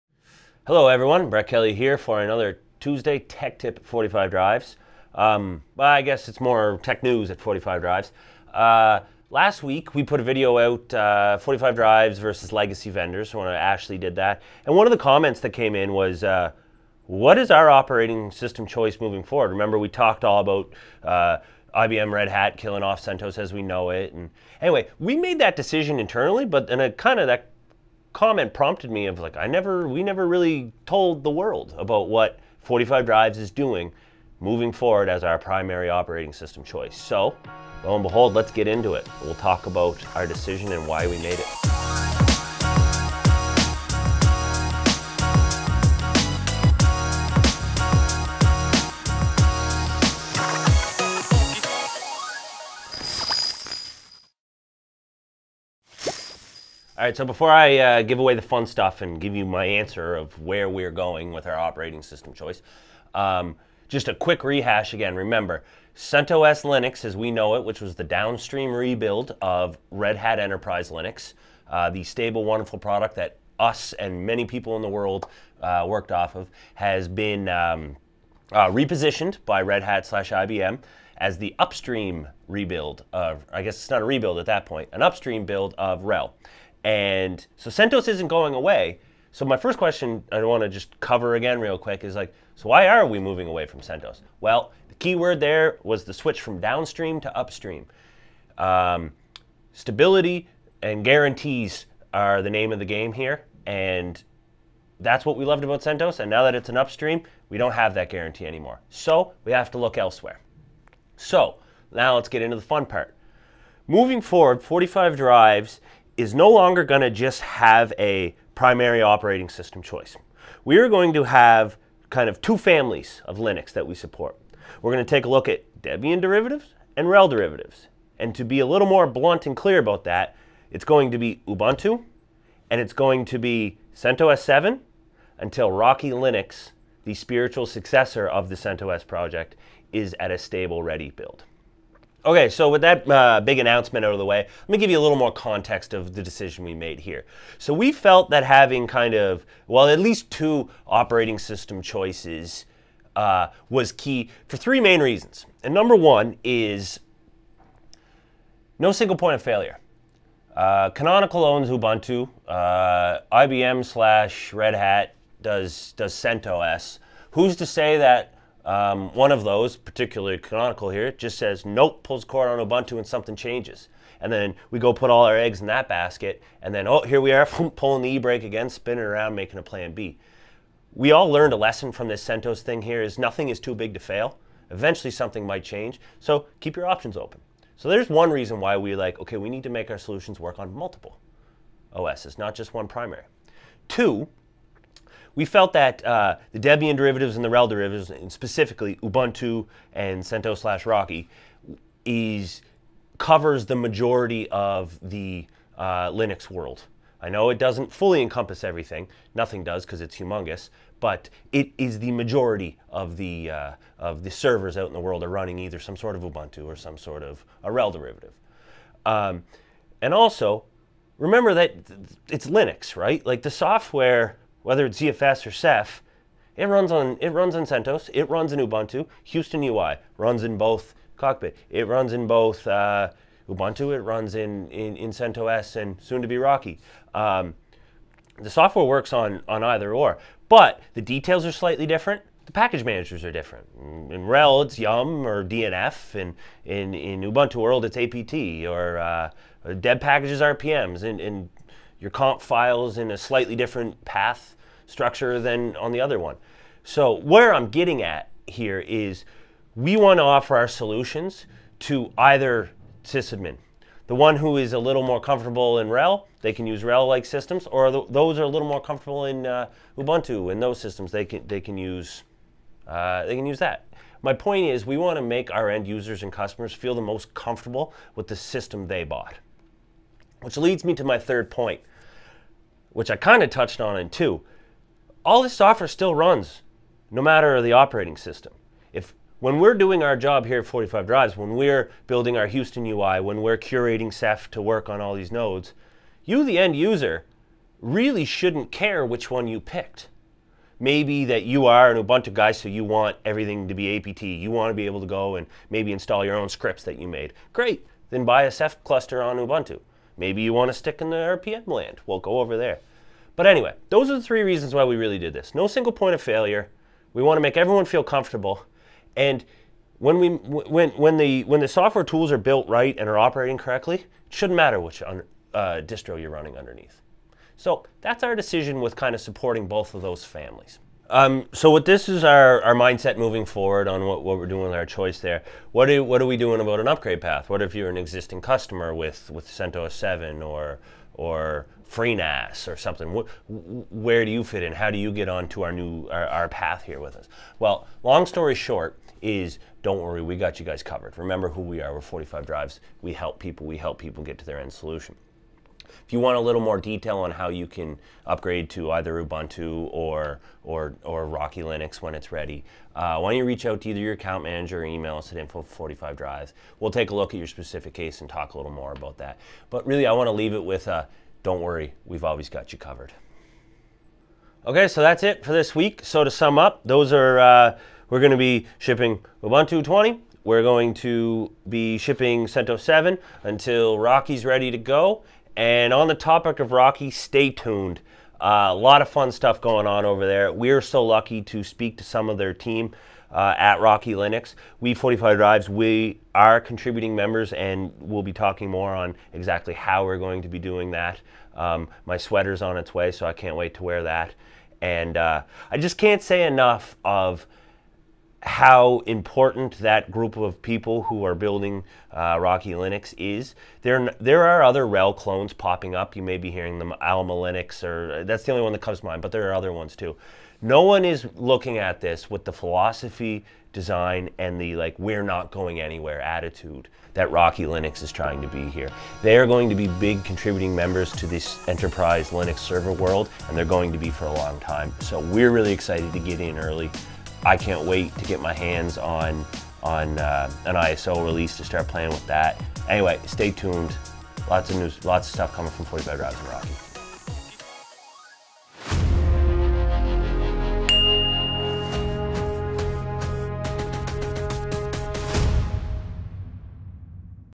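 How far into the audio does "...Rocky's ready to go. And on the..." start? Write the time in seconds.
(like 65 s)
383 s.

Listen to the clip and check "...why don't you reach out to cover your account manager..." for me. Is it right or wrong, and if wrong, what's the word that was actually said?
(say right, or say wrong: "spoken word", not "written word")
wrong: "either", not "cover".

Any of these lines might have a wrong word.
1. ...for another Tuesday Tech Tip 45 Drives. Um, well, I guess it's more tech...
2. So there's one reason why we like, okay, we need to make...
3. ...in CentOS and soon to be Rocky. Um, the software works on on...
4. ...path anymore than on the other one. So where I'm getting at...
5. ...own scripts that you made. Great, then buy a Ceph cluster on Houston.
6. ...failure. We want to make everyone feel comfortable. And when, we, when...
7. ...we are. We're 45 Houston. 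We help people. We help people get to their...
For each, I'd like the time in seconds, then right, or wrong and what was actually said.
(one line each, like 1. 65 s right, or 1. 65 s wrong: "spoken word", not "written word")
1. 1 s right
2. 187 s right
3. 234 s right
4. 254 s wrong: "structure", not "anymore"
5. 306 s wrong: "Ubuntu", not "Houston"
6. 316 s right
7. 351 s wrong: "Drives", not "Houston".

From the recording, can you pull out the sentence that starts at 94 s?
Well, the key word there was the switch from downstream to upstream.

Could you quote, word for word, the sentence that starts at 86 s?
And so CentOS isn't going away.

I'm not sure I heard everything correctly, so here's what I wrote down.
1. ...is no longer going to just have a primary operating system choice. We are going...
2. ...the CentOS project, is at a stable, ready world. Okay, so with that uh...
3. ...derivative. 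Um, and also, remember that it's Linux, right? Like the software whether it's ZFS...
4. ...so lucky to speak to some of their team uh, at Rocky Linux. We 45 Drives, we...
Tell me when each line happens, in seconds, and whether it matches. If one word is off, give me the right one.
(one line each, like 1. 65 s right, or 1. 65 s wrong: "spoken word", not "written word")
1. 116 s right
2. 138 s wrong: "build", not "world"
3. 217 s right
4. 390 s right.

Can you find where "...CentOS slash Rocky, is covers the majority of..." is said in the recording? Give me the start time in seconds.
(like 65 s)
200 s.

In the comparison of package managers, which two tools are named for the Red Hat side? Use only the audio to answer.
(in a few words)
Yum or DNF.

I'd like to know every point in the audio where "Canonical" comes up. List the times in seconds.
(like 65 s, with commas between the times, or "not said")
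160 s, 170 s.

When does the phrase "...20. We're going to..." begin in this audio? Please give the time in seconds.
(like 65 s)
379 s.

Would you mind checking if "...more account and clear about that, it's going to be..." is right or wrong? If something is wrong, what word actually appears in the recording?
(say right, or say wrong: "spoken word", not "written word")
wrong: "blunt", not "account".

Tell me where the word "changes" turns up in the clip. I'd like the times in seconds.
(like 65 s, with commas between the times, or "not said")
173 s, 185 s.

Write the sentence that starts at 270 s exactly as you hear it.
In those systems, they can they can use uh, they can use that.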